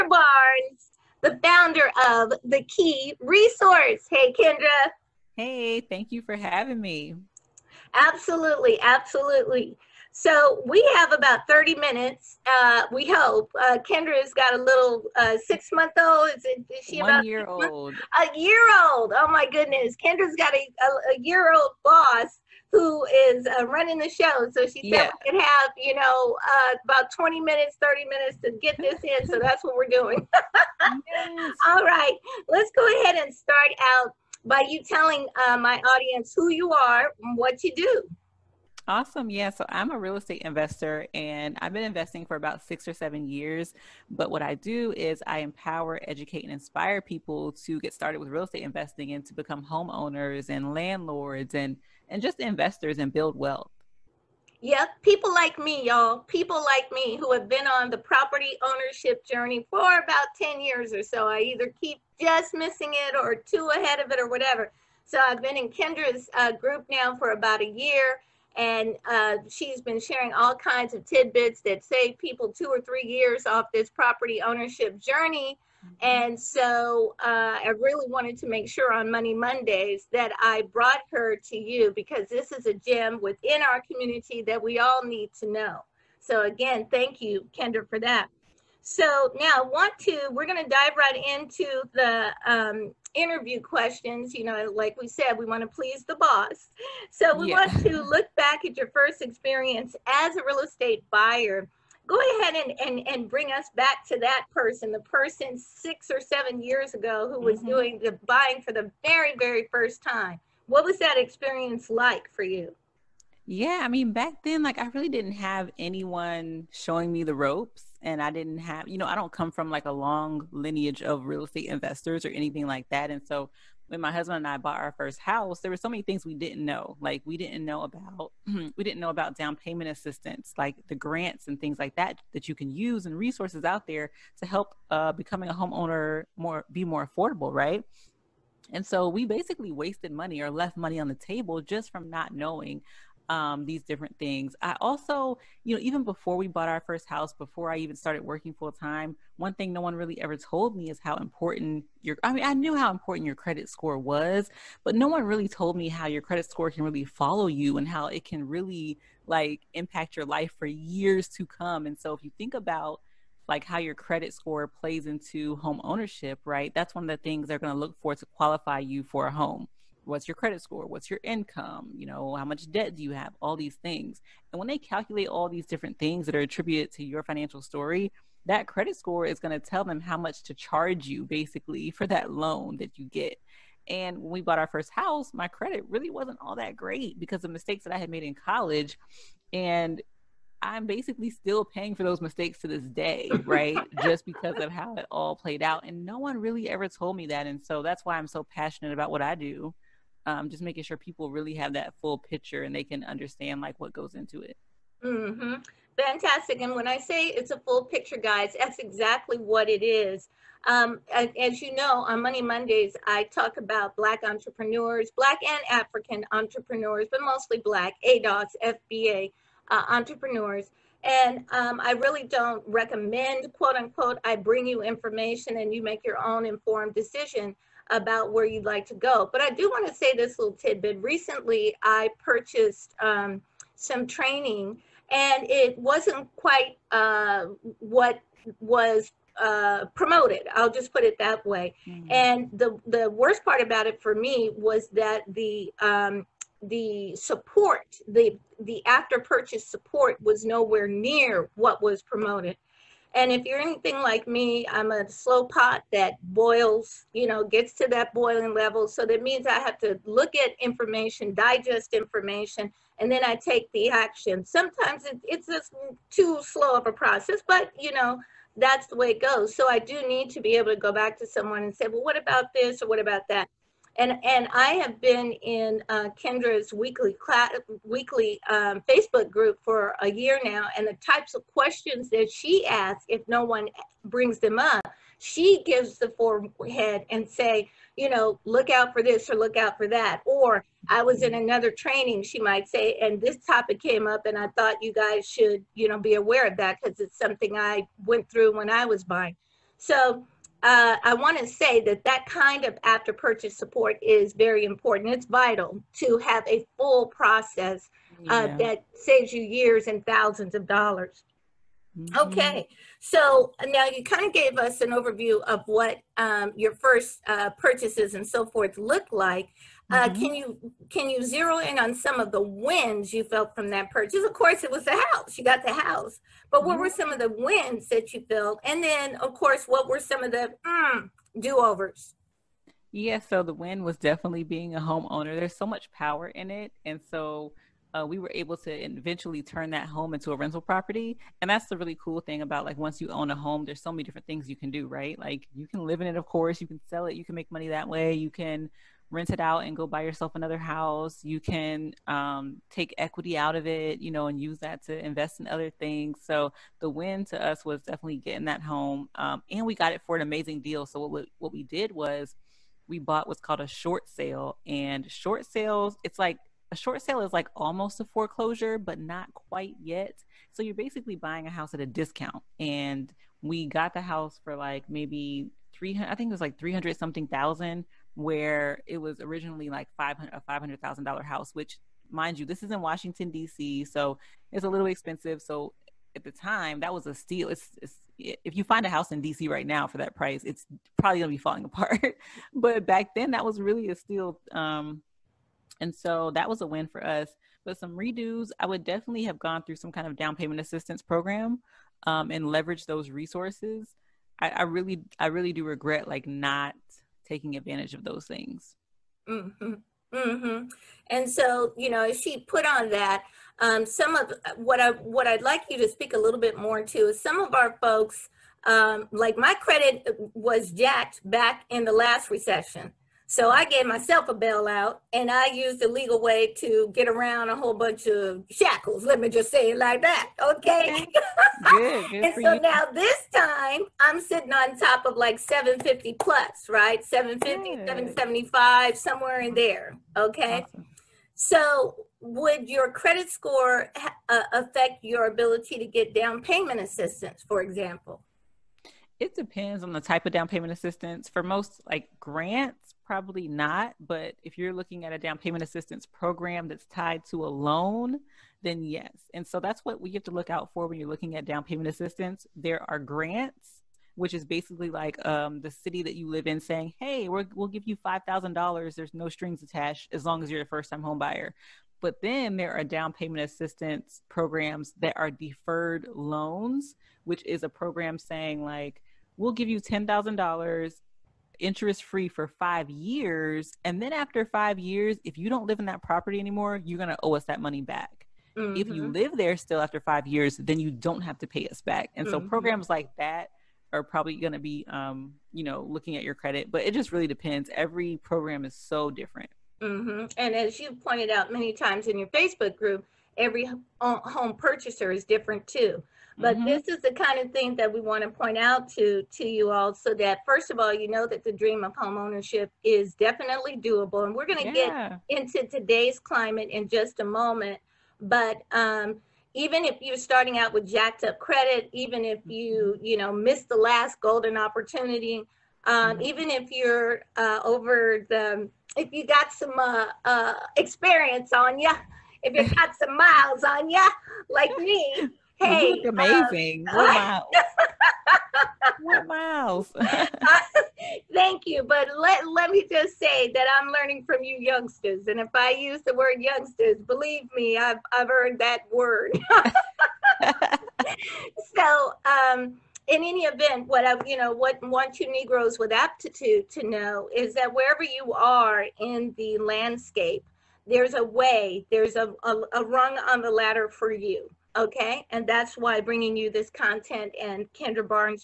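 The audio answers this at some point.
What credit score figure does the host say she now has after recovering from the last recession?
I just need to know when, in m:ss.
7:17.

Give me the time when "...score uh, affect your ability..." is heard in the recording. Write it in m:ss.
7:23.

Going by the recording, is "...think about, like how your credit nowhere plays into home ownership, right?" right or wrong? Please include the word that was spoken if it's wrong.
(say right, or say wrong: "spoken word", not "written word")
wrong: "score", not "nowhere".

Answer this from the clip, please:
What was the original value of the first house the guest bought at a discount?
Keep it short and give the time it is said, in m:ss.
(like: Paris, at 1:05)
$500,000, at 6:20.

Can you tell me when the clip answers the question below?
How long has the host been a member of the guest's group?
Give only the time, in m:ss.
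1:07.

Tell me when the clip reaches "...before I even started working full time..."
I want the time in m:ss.
2:27.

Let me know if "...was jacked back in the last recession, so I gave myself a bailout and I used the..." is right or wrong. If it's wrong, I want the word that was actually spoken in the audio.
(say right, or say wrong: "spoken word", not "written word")
right.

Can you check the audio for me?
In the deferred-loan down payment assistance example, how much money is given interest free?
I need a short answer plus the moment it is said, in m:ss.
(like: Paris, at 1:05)
$10,000, at 7:59.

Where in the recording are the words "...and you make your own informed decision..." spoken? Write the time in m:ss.
3:45.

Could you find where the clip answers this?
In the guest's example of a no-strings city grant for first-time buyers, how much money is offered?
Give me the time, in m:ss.
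7:47.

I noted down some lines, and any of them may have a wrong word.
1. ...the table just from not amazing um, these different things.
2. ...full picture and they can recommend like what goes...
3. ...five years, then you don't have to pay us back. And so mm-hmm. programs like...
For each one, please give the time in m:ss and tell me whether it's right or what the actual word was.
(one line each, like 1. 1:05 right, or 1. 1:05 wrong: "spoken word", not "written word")
1. 2:21 wrong: "knowing", not "amazing"
2. 3:22 wrong: "understand", not "recommend"
3. 8:10 right.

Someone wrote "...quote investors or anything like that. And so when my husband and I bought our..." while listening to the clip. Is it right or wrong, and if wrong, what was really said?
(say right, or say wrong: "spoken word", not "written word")
wrong: "estate", not "quote".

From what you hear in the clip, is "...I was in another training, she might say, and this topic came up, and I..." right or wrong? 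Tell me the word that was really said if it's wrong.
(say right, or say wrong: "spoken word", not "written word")
right.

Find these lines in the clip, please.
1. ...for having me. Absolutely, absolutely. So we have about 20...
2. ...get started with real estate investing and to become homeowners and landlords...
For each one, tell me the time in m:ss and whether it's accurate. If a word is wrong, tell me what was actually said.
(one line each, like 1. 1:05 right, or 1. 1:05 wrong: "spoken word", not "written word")
1. 0:06 wrong: "30", not "20"
2. 0:47 right.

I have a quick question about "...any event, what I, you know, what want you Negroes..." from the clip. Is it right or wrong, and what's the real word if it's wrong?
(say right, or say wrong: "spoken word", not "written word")
right.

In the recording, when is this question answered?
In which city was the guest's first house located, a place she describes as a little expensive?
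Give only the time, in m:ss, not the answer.
6:22.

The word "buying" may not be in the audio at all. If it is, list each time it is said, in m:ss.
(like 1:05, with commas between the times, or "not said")
1:48, 4:59, 6:11.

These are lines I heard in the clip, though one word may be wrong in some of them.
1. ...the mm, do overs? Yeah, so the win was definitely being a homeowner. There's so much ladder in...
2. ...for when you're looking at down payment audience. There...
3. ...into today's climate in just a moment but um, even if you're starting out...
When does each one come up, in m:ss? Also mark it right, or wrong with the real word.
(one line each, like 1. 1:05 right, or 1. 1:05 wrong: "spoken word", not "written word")
1. 5:30 wrong: "power", not "ladder"
2. 7:40 wrong: "assistance", not "audience"
3. 8:35 right.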